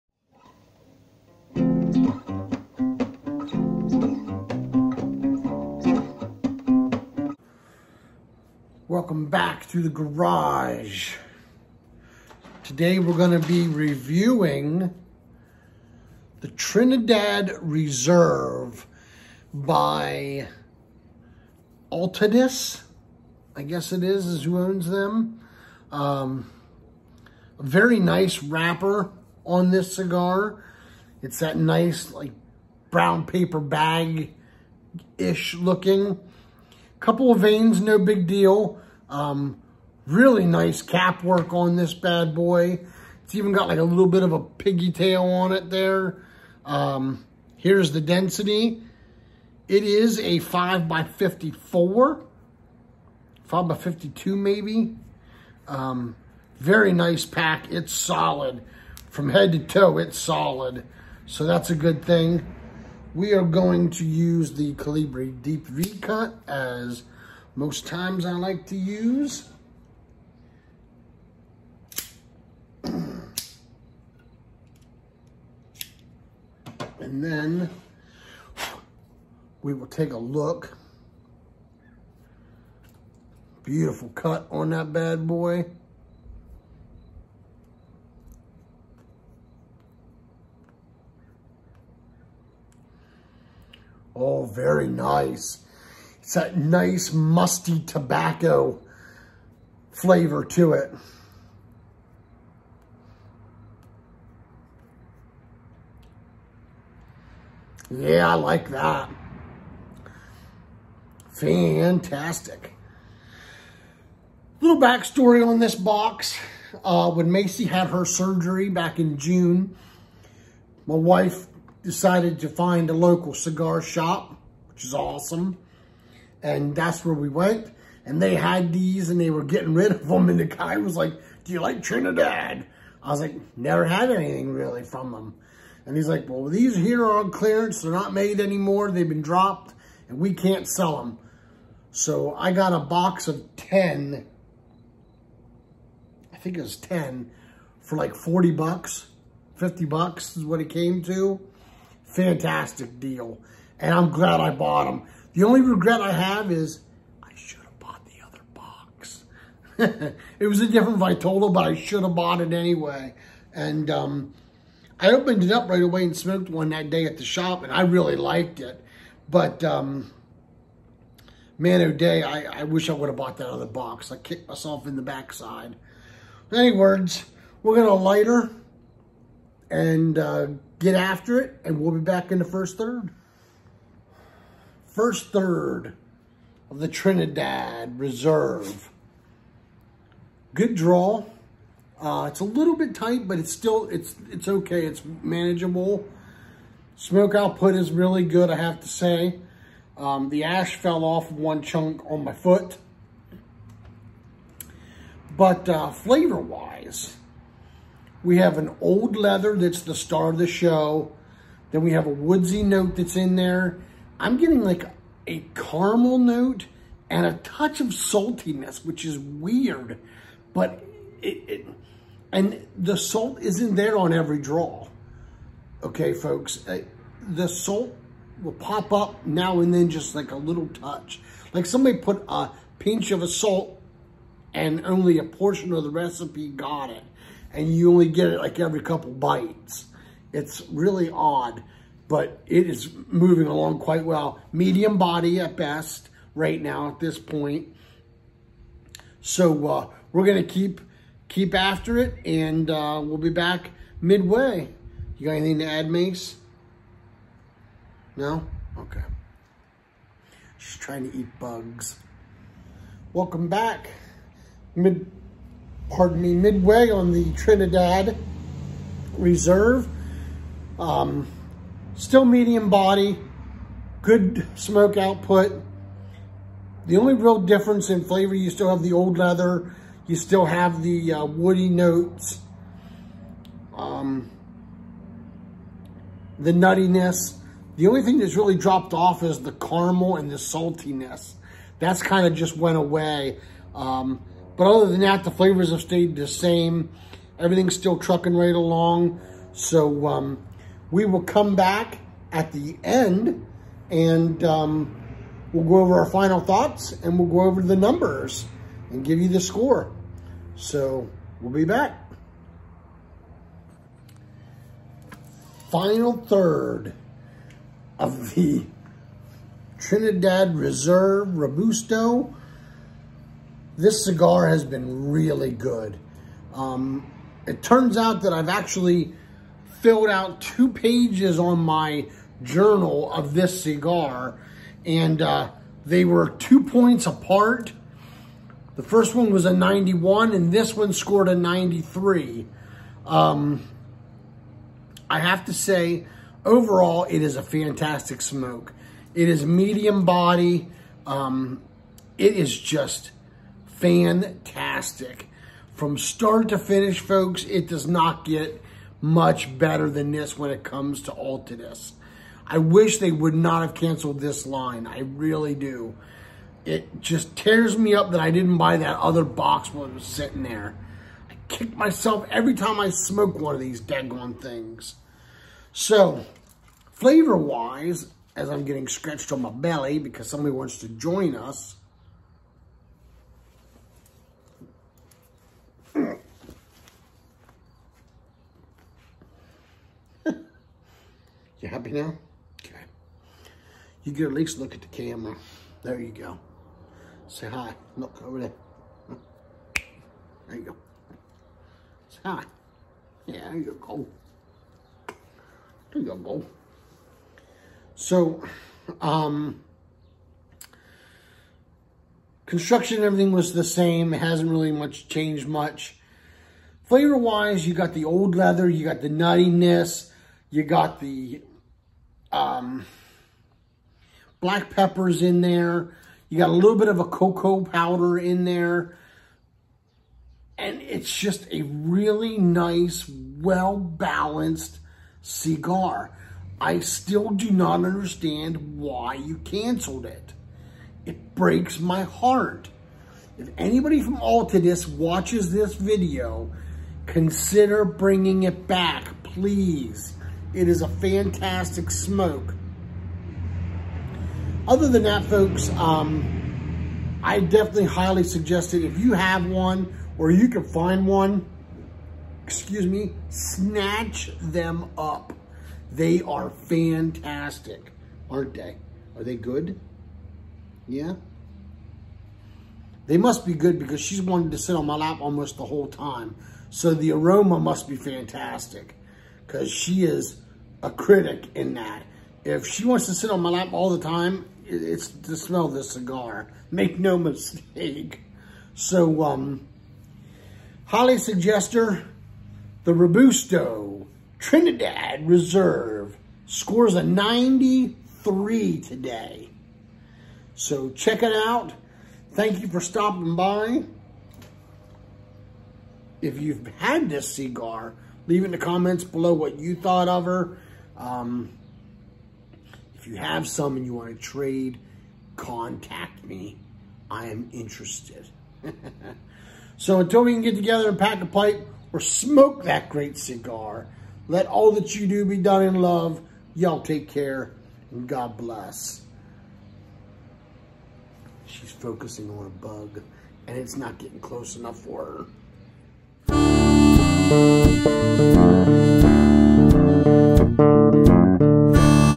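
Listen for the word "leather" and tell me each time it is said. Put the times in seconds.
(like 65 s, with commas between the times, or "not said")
209 s, 279 s, 418 s.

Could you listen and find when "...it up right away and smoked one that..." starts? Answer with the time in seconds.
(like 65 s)
165 s.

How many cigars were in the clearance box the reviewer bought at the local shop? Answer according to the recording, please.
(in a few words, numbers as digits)
10.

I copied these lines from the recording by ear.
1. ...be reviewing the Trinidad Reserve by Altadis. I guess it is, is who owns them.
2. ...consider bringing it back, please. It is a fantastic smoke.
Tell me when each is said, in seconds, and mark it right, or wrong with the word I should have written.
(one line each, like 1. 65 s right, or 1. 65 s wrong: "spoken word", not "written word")
1. 13 s right
2. 447 s right.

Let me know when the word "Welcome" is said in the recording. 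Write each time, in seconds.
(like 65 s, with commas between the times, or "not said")
8 s, 263 s.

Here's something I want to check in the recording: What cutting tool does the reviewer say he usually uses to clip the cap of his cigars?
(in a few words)
Colibri Deep V-Cut.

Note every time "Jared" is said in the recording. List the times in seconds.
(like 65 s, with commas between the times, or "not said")
not said.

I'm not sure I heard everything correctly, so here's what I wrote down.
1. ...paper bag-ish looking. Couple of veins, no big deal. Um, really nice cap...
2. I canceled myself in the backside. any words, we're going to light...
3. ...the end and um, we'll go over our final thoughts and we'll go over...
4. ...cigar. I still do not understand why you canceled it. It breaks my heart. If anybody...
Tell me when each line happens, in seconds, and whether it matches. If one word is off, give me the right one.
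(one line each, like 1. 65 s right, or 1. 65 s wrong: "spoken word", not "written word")
1. 33 s right
2. 174 s wrong: "kicked", not "canceled"
3. 302 s right
4. 435 s right.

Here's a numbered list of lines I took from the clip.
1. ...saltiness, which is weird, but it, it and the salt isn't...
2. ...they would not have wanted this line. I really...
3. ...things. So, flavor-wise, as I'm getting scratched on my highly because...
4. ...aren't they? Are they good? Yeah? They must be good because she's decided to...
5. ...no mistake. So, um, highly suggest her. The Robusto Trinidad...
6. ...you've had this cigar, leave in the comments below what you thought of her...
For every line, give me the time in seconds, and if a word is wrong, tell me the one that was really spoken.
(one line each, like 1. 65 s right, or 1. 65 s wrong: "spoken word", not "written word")
1. 217 s right
2. 362 s wrong: "canceled", not "wanted"
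3. 374 s wrong: "belly", not "highly"
4. 468 s wrong: "wanted", not "decided"
5. 486 s right
6. 506 s right.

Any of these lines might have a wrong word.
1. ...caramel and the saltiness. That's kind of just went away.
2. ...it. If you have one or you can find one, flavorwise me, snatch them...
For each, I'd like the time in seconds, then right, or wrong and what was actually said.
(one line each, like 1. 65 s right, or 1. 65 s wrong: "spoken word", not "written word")
1. 289 s right
2. 458 s wrong: "excuse", not "flavorwise".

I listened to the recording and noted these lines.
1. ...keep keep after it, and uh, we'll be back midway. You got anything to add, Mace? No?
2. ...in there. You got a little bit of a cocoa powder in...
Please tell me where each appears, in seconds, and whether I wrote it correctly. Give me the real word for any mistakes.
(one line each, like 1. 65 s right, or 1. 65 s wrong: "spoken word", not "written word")
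1. 250 s right
2. 425 s right.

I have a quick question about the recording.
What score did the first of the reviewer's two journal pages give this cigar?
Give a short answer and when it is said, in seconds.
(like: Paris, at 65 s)
91, at 339 s.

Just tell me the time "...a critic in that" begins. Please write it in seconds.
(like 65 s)
480 s.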